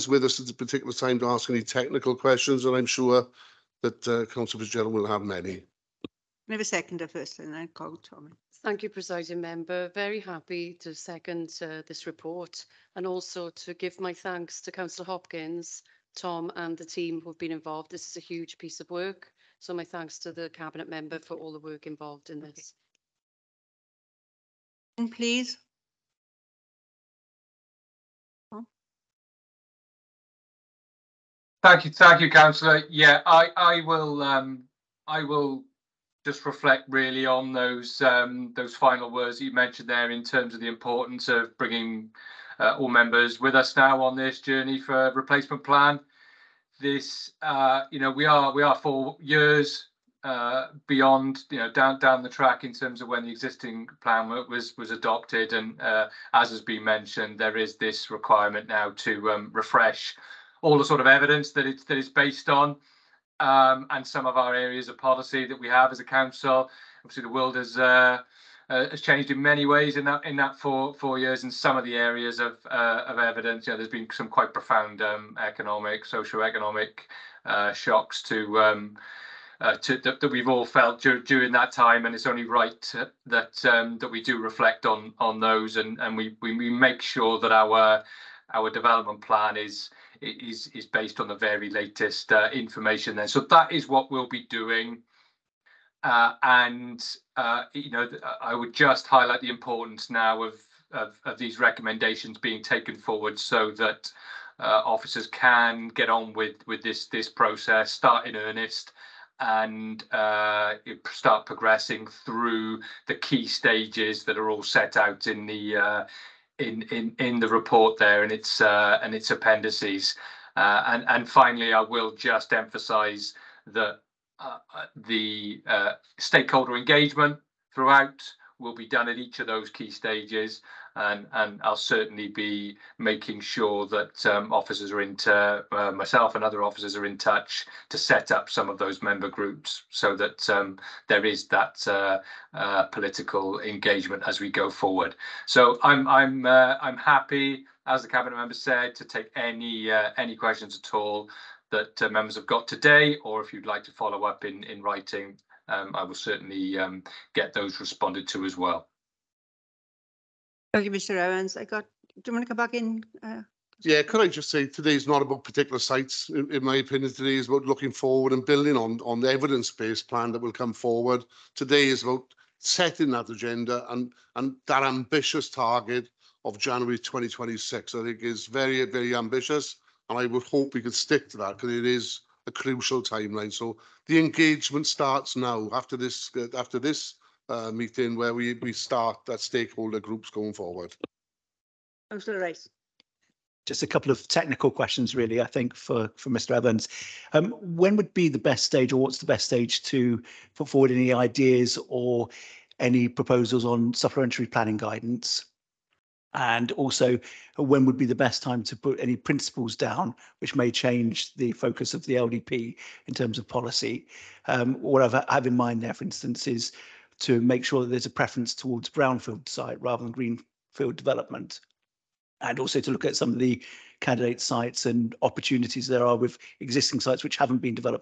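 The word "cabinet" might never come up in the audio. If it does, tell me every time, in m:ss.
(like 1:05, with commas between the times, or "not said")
0:20, 2:28.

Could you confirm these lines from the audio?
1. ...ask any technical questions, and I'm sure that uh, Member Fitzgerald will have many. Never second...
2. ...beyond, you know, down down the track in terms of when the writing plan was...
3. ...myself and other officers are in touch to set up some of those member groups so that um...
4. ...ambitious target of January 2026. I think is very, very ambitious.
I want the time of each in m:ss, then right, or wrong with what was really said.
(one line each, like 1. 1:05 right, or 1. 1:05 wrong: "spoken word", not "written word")
1. 0:01 wrong: "Councillor", not "Member"
2. 0:50 wrong: "existing", not "writing"
3. 2:15 right
4. 2:54 right.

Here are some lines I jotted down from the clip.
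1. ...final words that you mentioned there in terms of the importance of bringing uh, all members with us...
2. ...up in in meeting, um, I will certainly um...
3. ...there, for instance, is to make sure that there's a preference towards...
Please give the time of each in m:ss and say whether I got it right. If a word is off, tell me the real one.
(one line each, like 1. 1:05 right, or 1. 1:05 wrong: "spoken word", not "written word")
1. 0:38 right
2. 2:34 wrong: "writing", not "meeting"
3. 3:35 right.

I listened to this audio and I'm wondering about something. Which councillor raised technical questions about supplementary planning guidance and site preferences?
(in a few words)
Councillor Rice.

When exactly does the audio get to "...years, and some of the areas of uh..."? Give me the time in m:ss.
1:11.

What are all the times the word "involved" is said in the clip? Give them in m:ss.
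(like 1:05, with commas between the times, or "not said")
0:17, 0:21.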